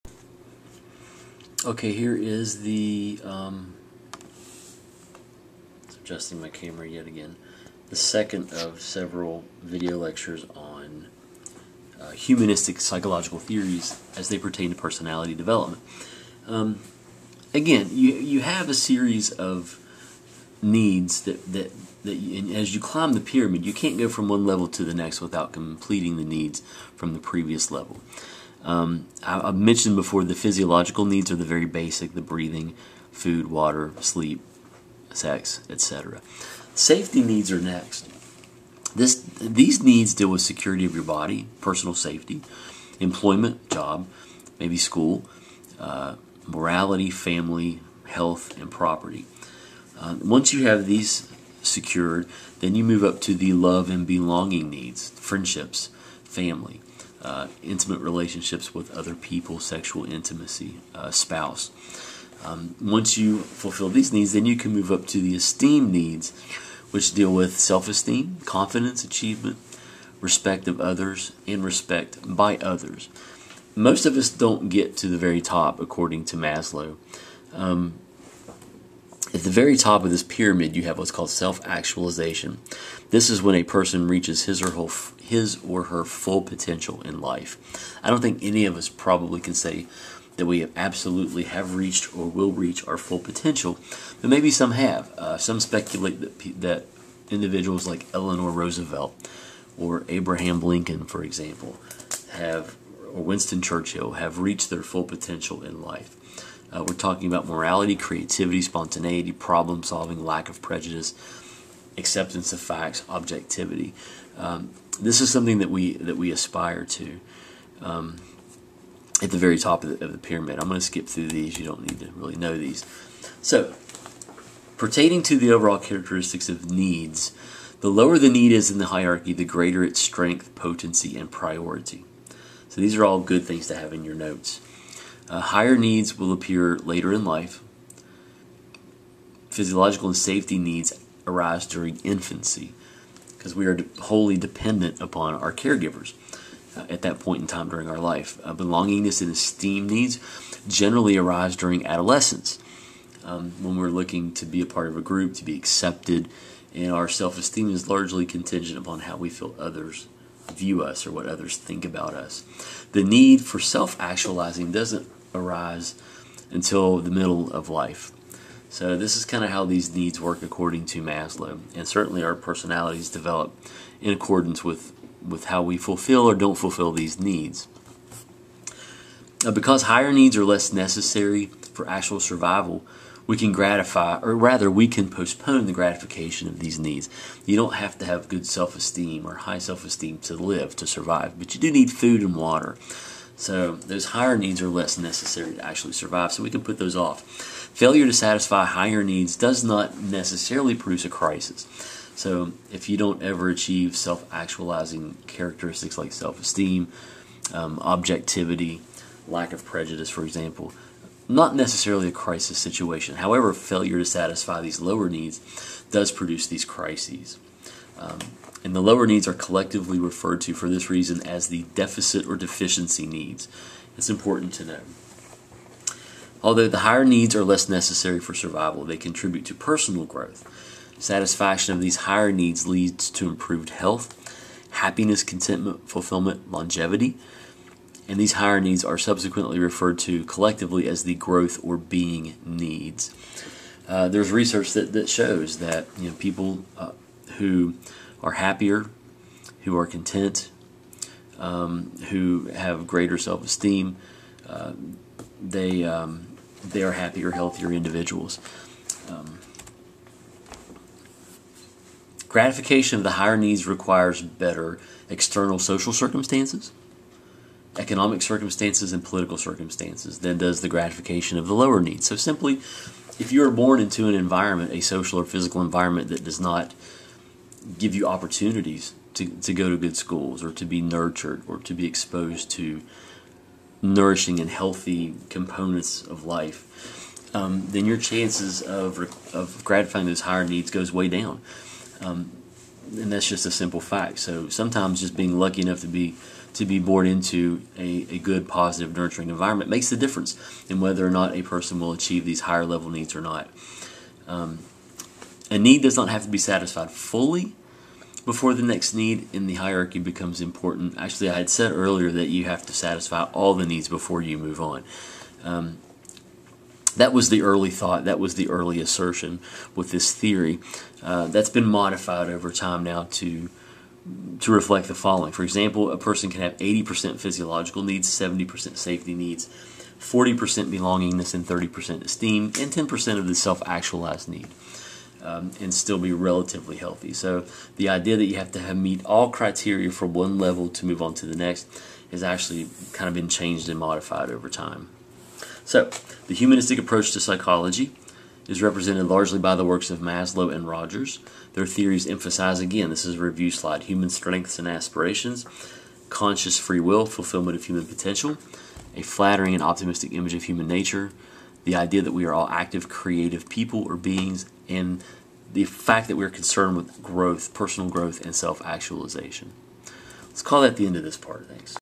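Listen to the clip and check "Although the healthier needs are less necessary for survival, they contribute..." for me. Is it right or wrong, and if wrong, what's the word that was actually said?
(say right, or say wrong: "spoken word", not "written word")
wrong: "higher", not "healthier".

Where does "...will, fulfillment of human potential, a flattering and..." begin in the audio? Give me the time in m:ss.
5:56.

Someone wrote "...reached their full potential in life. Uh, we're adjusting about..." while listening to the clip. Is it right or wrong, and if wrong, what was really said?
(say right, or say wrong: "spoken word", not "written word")
wrong: "talking", not "adjusting".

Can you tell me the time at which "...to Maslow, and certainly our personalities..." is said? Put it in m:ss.
2:50.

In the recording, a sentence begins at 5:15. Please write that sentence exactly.
Um, that was the early thought, that was the early assertion with this theory.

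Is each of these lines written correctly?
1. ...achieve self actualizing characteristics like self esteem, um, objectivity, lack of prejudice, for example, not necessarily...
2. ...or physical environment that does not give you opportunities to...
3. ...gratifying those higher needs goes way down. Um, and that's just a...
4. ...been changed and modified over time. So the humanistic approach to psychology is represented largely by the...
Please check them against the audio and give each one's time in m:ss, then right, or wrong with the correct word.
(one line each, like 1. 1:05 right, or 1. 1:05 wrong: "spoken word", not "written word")
1. 3:23 right
2. 4:35 right
3. 4:49 right
4. 5:43 right.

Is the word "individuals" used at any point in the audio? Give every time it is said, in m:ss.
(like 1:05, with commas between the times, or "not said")
1:37, 4:17.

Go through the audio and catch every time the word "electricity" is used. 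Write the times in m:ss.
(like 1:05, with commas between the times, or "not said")
not said.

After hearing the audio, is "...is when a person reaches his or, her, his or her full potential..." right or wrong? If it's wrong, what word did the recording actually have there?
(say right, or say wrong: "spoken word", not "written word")
right.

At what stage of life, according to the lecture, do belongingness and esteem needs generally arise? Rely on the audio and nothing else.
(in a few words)
adolescence.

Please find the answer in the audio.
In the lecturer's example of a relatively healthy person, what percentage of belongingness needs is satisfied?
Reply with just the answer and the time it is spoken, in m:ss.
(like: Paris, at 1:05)
40%, at 5:29.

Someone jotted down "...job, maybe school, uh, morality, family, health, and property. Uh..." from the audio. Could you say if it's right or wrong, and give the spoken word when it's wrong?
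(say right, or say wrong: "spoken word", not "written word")
right.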